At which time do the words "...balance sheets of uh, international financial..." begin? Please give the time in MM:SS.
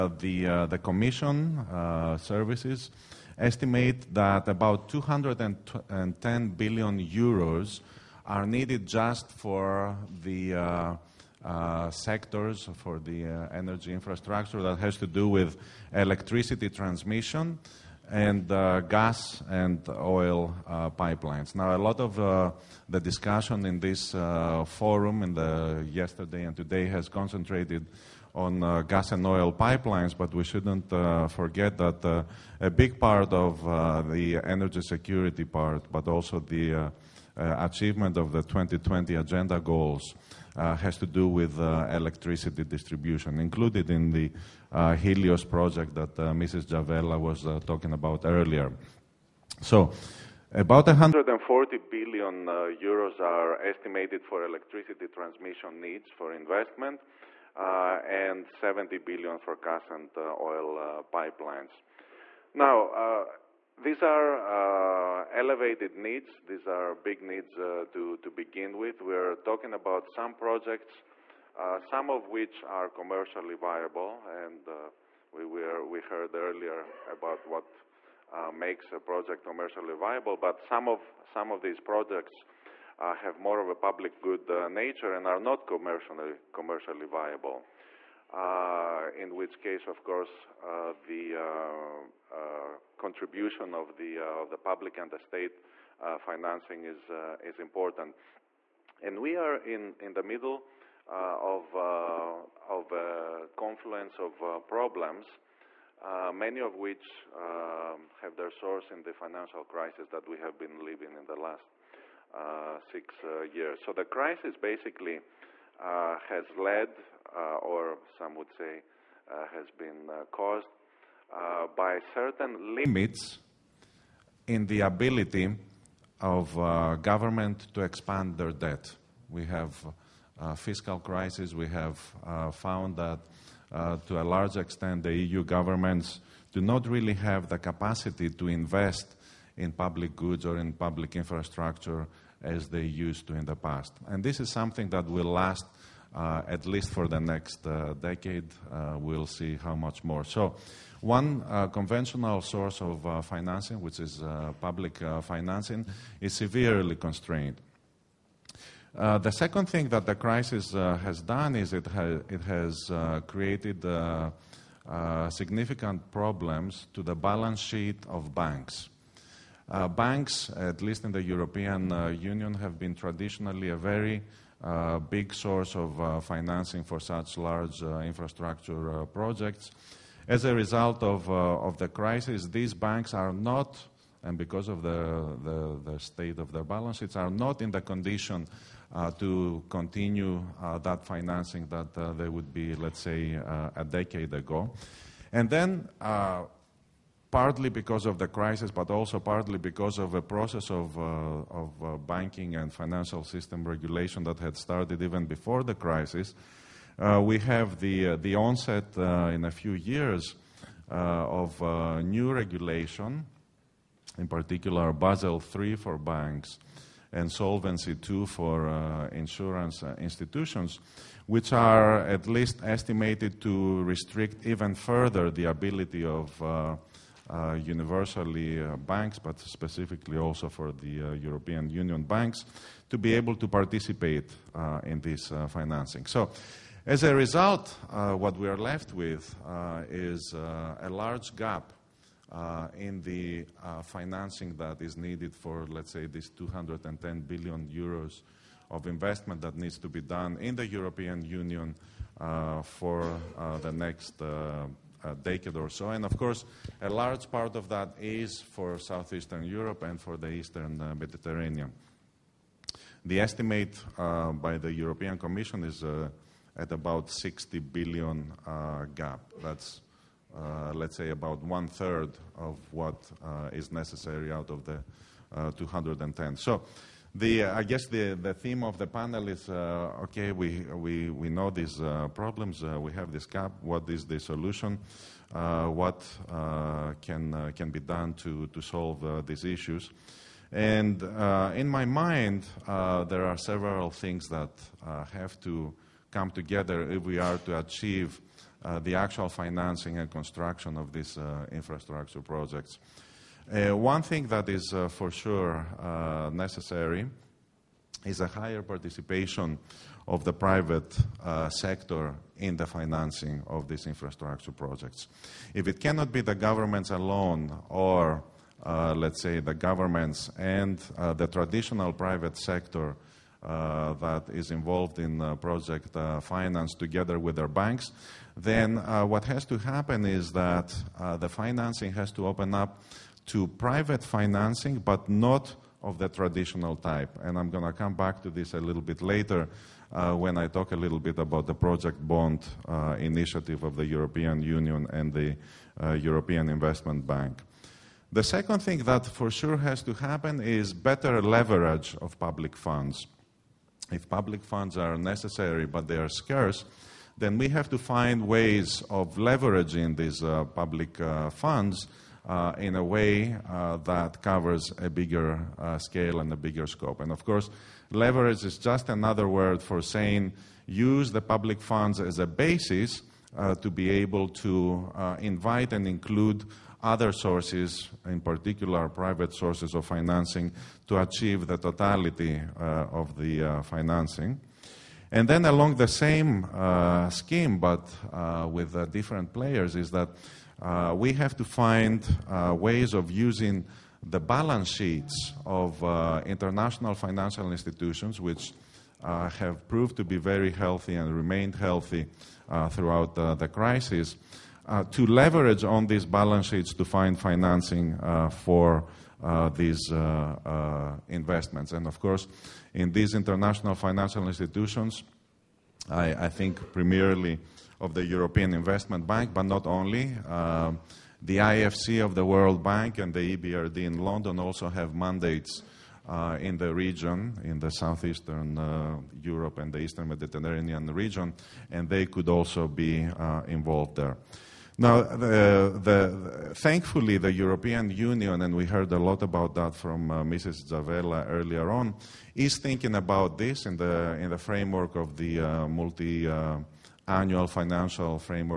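06:34.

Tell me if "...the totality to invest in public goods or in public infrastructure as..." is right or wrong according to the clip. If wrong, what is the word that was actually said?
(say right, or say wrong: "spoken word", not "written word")
wrong: "capacity", not "totality".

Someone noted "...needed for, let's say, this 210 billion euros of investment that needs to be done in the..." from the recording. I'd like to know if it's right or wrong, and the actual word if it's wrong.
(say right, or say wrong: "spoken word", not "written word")
right.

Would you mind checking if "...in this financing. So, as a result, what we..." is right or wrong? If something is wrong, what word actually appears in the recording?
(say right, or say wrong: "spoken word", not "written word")
right.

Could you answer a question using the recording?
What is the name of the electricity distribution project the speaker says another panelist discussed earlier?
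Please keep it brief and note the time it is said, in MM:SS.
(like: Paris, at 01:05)
Helios, at 00:44.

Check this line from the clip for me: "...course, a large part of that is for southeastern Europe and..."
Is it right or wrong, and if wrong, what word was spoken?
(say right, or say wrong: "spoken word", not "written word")
right.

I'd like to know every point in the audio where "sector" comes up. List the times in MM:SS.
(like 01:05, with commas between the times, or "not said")
00:11, 05:11, 05:22.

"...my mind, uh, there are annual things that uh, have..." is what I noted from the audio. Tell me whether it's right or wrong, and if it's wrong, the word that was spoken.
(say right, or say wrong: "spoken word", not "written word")
wrong: "several", not "annual".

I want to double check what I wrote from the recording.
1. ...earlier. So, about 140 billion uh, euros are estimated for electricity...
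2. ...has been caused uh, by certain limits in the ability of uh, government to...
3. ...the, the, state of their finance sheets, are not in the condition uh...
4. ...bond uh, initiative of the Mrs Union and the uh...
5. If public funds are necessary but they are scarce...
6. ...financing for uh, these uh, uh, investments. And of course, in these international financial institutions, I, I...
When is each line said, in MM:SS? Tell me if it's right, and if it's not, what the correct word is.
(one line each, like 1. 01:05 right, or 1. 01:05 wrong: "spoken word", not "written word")
1. 00:48 right
2. 01:59 right
3. 03:05 wrong: "balance", not "finance"
4. 05:42 wrong: "European", not "Mrs"
5. 05:53 right
6. 06:47 right.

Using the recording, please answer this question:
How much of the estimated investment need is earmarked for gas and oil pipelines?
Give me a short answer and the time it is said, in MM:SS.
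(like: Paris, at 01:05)
70 billion, at 00:58.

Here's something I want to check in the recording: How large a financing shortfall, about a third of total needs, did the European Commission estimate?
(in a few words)
60 billion.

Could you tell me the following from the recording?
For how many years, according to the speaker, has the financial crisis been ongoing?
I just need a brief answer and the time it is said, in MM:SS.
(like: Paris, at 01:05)
6, at 01:52.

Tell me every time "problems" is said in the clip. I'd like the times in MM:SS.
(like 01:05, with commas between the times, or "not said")
01:44, 02:46, 04:42.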